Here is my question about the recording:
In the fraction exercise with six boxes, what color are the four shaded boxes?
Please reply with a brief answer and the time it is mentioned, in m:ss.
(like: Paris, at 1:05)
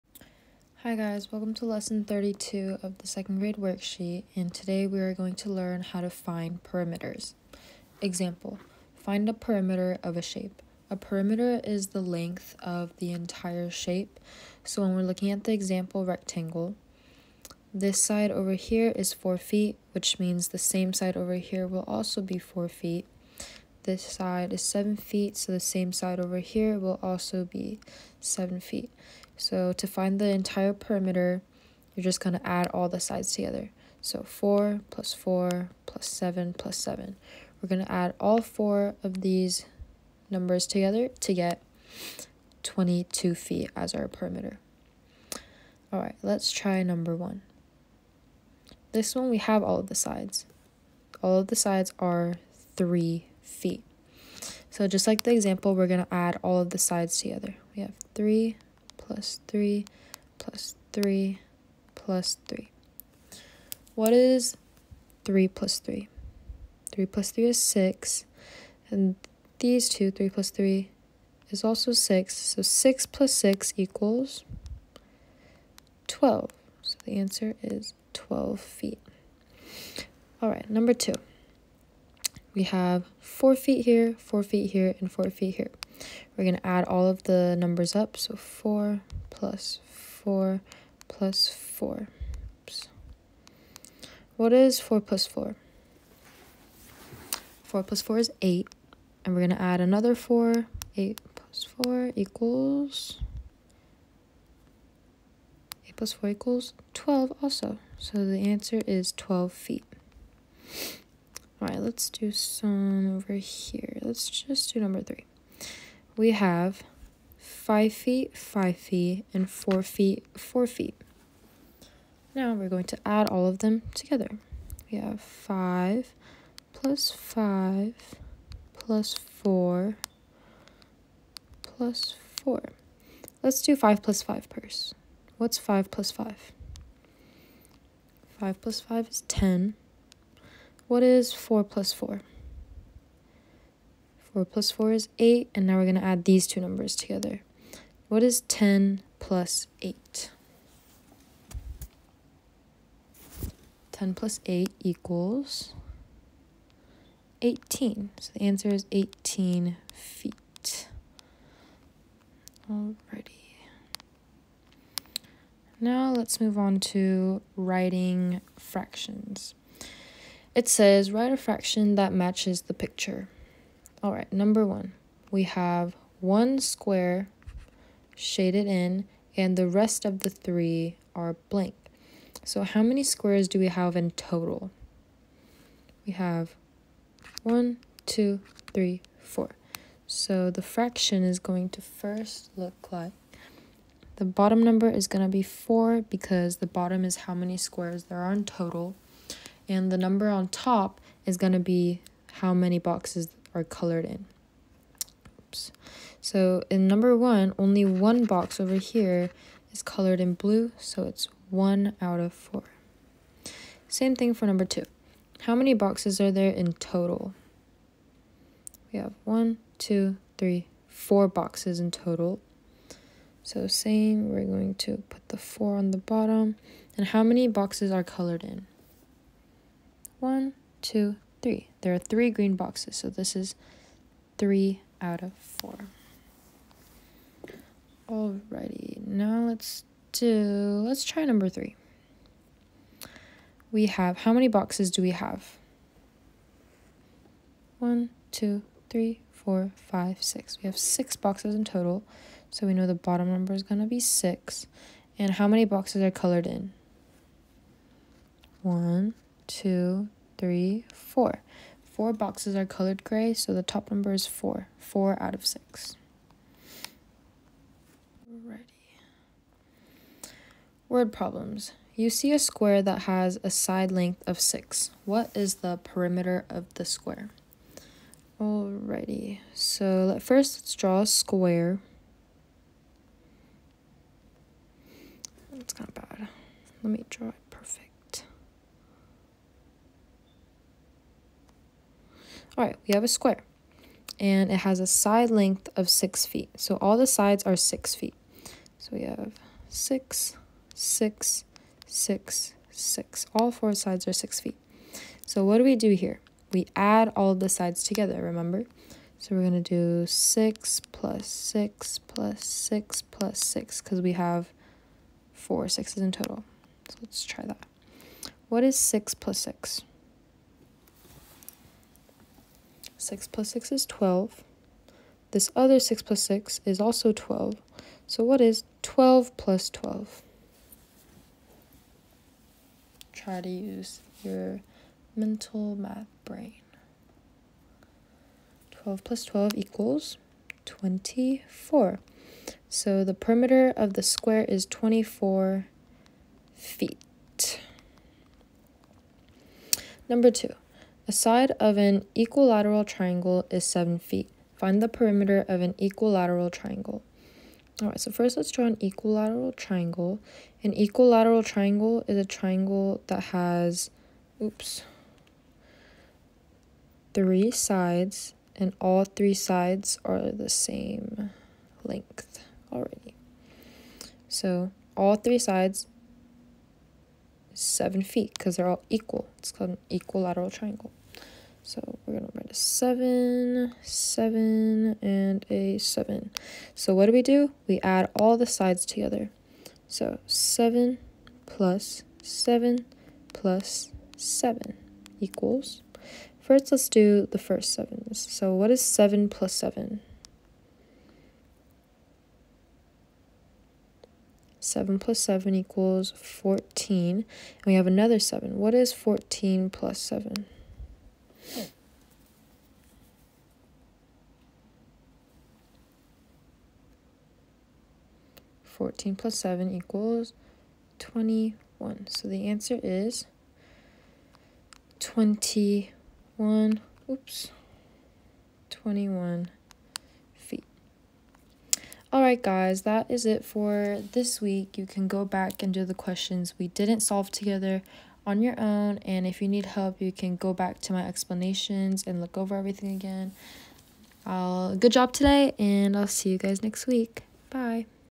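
gray, at 4:23.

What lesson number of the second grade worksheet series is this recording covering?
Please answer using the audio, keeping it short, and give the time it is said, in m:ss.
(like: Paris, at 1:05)
32, at 0:01.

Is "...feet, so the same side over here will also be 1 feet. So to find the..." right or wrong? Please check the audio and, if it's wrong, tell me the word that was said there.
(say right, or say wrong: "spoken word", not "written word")
wrong: "7", not "1".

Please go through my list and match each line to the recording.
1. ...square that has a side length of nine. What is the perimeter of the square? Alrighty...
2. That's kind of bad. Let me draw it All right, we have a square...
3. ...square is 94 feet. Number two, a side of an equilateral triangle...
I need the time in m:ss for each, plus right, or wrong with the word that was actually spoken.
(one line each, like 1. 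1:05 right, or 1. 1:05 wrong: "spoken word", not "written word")
1. 4:32 wrong: "six", not "nine"
2. 4:45 right
3. 5:44 wrong: "24", not "94".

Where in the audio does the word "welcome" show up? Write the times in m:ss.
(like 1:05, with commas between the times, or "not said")
0:01.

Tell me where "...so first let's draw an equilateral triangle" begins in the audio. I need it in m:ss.
5:57.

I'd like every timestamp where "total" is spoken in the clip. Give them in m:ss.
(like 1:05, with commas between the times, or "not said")
3:04, 3:18, 3:36, 3:41, 4:11, 5:16.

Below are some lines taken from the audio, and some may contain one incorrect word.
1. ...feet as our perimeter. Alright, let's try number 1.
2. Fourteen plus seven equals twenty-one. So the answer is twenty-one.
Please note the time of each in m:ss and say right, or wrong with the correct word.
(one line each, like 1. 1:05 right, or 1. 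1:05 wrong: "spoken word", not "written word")
1. 0:43 right
2. 6:58 right.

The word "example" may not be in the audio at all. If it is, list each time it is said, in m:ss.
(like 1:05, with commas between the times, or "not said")
0:08, 0:15, 0:55.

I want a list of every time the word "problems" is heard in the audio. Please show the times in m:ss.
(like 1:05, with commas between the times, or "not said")
4:31.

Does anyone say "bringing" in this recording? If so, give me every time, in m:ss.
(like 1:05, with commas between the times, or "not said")
not said.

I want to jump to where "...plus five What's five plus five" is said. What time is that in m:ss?
2:14.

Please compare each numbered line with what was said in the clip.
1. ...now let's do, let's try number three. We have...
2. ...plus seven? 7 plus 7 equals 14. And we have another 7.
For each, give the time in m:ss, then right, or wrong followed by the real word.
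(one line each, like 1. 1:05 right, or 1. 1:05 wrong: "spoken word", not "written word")
1. 3:59 right
2. 6:39 right.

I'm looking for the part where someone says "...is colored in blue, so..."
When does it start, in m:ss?
3:29.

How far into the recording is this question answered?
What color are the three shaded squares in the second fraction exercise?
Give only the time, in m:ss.
3:52.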